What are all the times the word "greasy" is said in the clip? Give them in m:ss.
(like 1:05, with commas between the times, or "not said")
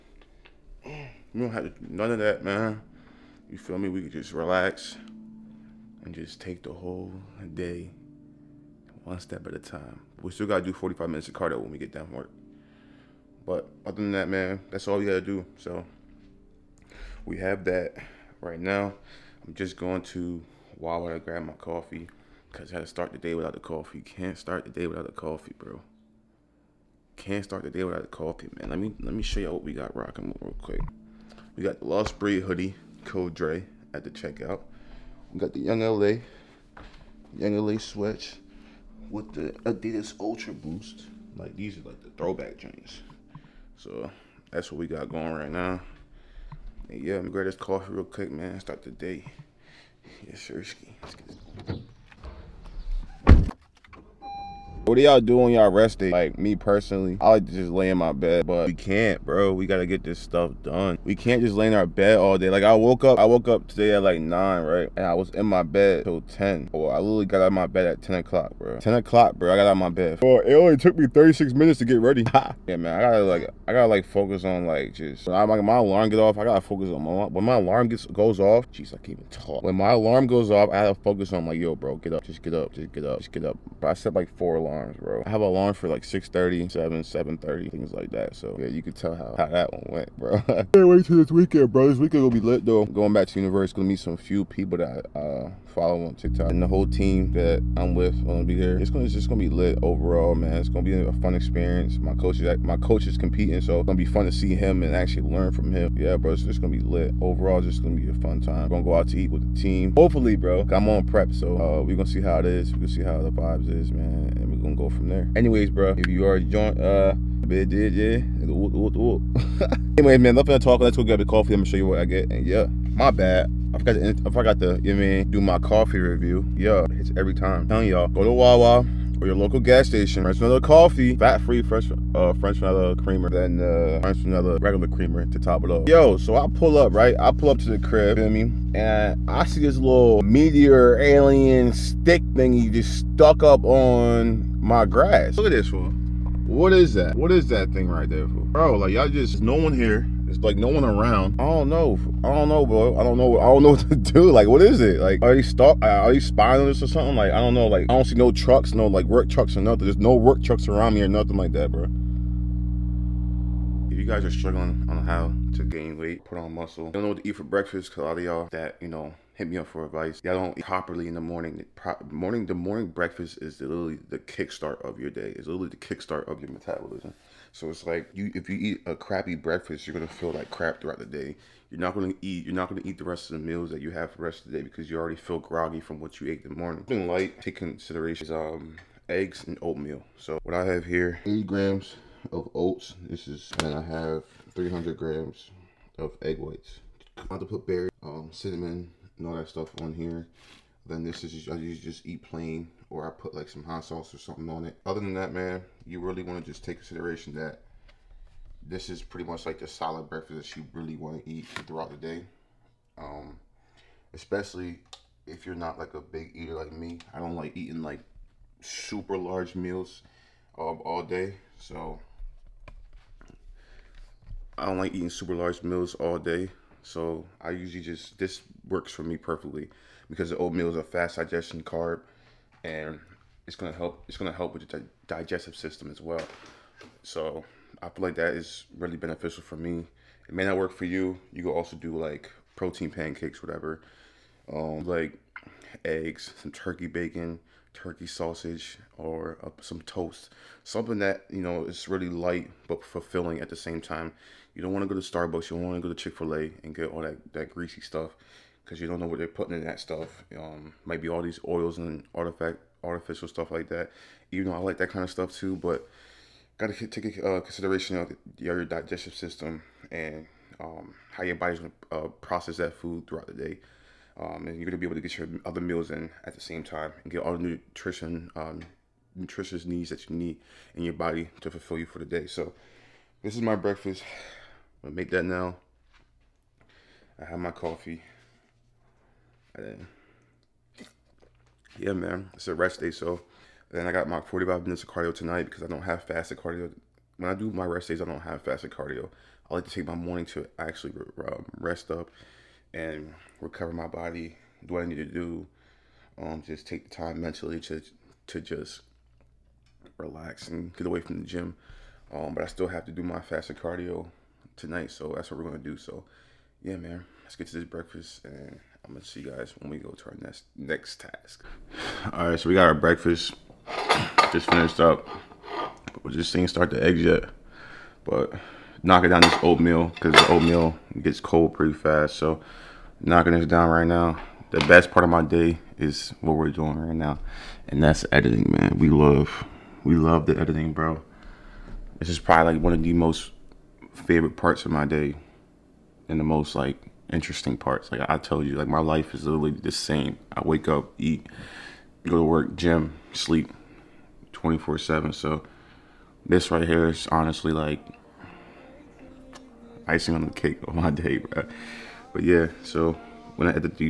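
4:17.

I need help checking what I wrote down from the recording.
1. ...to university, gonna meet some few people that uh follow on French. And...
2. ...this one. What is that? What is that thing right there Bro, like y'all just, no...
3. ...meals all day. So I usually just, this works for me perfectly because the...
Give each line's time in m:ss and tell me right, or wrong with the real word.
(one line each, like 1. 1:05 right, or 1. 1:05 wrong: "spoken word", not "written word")
1. 1:33 wrong: "TikTok", not "French"
2. 2:25 right
3. 3:45 right.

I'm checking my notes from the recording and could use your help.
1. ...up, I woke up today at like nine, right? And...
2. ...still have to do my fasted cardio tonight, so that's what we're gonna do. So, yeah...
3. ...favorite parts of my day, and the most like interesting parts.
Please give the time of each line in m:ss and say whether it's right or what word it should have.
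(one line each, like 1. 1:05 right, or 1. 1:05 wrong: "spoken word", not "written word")
1. 1:03 right
2. 5:12 right
3. 5:43 right.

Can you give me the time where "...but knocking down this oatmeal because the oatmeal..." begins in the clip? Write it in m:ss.
5:28.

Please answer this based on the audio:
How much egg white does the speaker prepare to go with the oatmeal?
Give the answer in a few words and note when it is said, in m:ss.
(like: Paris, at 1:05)
300 grams, at 3:14.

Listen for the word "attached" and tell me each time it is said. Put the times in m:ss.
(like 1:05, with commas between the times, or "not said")
not said.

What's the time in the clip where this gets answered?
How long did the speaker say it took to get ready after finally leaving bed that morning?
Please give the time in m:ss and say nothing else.
1:11.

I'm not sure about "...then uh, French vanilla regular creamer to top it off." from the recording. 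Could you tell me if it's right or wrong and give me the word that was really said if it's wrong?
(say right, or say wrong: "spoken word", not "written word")
right.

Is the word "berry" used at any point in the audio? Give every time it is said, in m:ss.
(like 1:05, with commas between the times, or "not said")
3:17.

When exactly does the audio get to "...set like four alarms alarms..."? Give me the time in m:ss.
1:23.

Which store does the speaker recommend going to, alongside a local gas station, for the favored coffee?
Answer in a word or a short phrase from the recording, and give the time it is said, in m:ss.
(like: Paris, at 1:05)
Wawa, at 2:08.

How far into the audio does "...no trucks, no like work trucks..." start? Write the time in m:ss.
2:38.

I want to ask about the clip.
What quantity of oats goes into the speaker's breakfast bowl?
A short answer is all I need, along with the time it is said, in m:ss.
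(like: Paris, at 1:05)
80 grams, at 3:11.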